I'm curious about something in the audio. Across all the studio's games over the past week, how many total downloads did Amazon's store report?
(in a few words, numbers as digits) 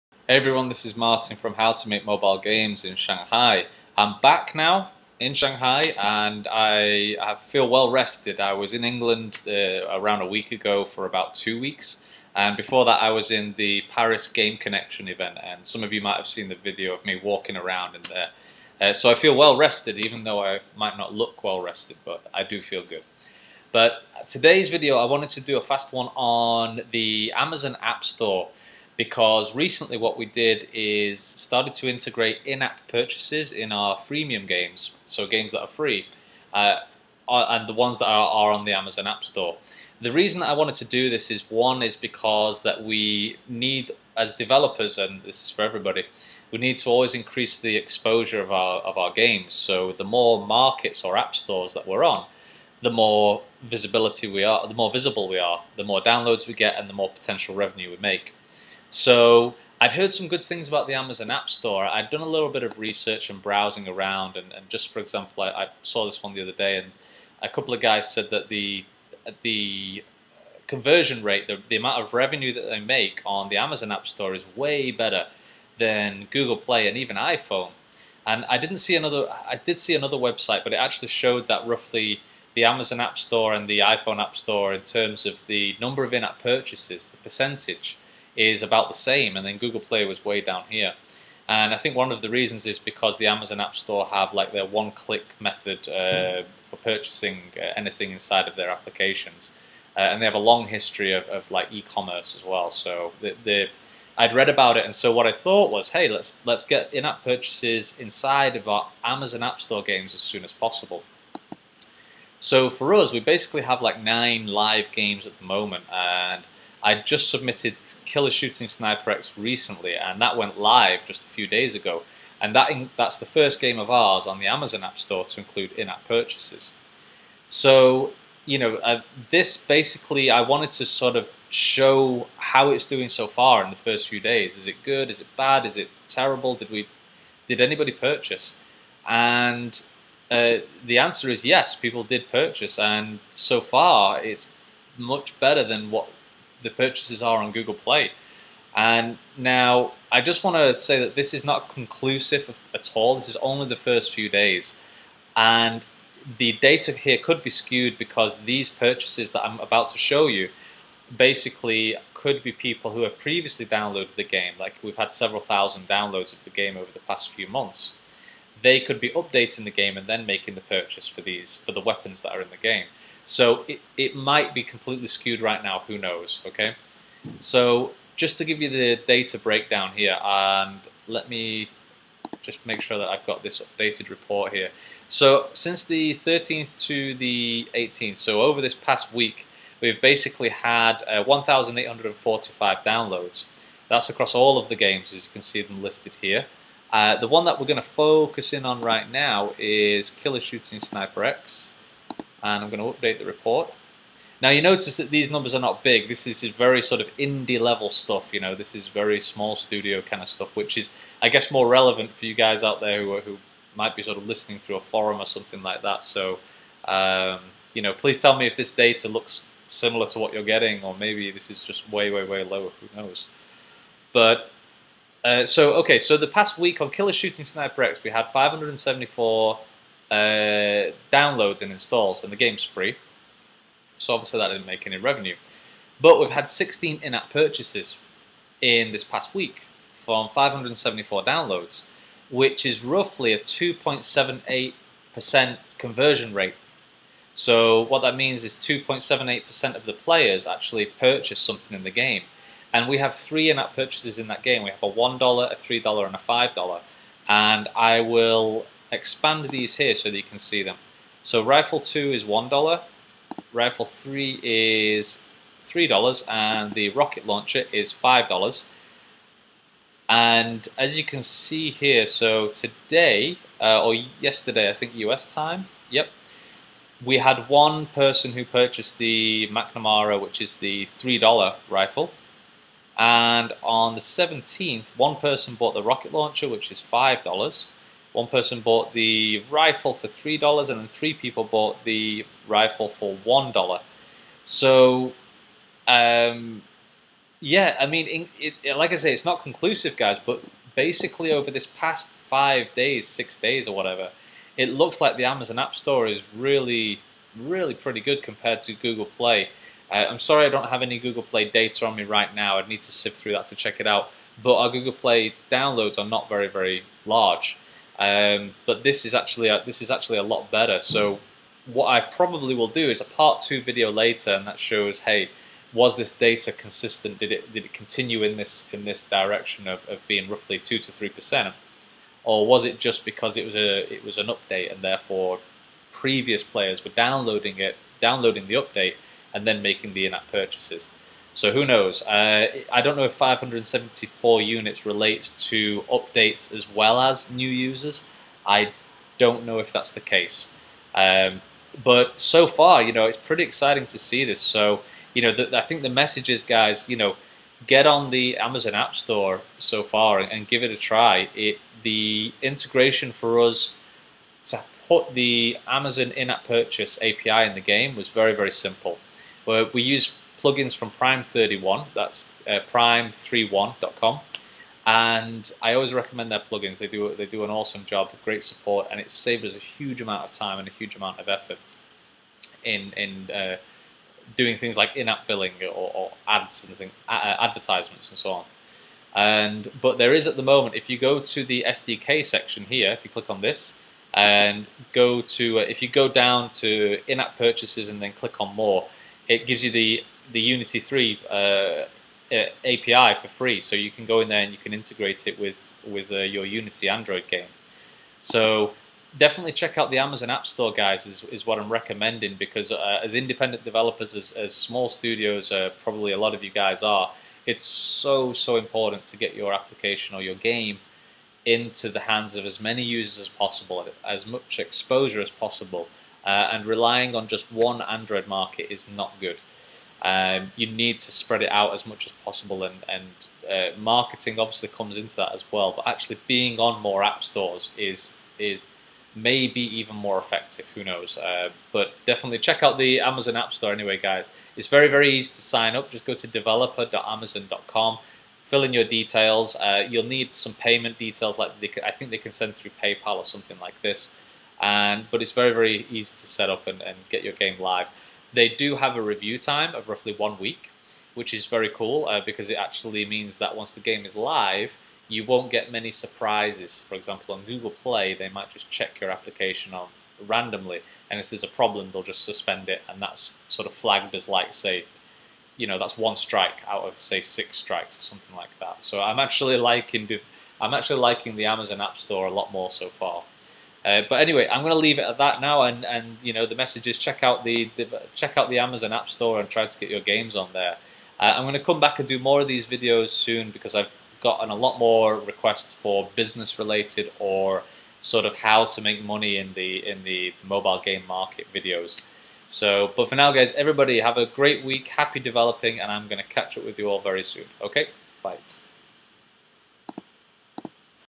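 1,845.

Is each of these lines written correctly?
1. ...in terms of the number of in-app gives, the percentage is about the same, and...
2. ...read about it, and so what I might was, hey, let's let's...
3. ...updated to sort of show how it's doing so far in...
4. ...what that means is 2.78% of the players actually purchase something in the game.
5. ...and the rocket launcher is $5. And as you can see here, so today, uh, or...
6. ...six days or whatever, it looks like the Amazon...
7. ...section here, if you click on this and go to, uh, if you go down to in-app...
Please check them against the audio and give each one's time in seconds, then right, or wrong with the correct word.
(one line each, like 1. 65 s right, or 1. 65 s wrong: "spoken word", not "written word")
1. 84 s wrong: "purchases", not "gives"
2. 104 s wrong: "thought", not "might"
3. 130 s wrong: "wanted", not "updated"
4. 247 s right
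5. 266 s right
6. 303 s right
7. 392 s right.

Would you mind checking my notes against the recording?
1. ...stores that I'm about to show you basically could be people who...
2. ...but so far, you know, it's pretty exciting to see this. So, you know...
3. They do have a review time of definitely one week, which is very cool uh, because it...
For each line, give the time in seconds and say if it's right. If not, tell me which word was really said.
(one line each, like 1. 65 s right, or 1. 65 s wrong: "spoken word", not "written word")
1. 158 s wrong: "purchases", not "stores"
2. 351 s right
3. 458 s wrong: "roughly", not "definitely".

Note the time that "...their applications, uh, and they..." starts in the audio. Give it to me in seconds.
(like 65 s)
98 s.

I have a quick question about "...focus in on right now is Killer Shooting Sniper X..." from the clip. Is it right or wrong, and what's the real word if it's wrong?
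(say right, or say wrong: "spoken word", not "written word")
right.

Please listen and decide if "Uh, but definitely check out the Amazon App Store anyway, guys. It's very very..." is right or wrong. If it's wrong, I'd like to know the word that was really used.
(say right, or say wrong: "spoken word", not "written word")
right.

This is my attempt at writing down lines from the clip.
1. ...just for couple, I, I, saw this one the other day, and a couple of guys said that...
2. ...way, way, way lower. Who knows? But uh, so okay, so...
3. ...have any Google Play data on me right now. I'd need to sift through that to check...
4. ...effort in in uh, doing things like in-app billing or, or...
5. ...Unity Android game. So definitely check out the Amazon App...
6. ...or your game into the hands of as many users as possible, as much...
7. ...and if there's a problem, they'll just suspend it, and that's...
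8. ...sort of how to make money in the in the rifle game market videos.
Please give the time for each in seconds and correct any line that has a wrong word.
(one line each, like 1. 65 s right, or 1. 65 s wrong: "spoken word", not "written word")
1. 64 s wrong: "example", not "couple"
2. 221 s right
3. 310 s right
4. 381 s right
5. 406 s right
6. 420 s right
7. 471 s right
8. 497 s wrong: "mobile", not "rifle".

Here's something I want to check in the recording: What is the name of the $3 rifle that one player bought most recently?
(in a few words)
McNamara.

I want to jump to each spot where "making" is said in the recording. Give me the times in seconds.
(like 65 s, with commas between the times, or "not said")
170 s, 339 s.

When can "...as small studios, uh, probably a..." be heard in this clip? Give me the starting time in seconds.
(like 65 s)
414 s.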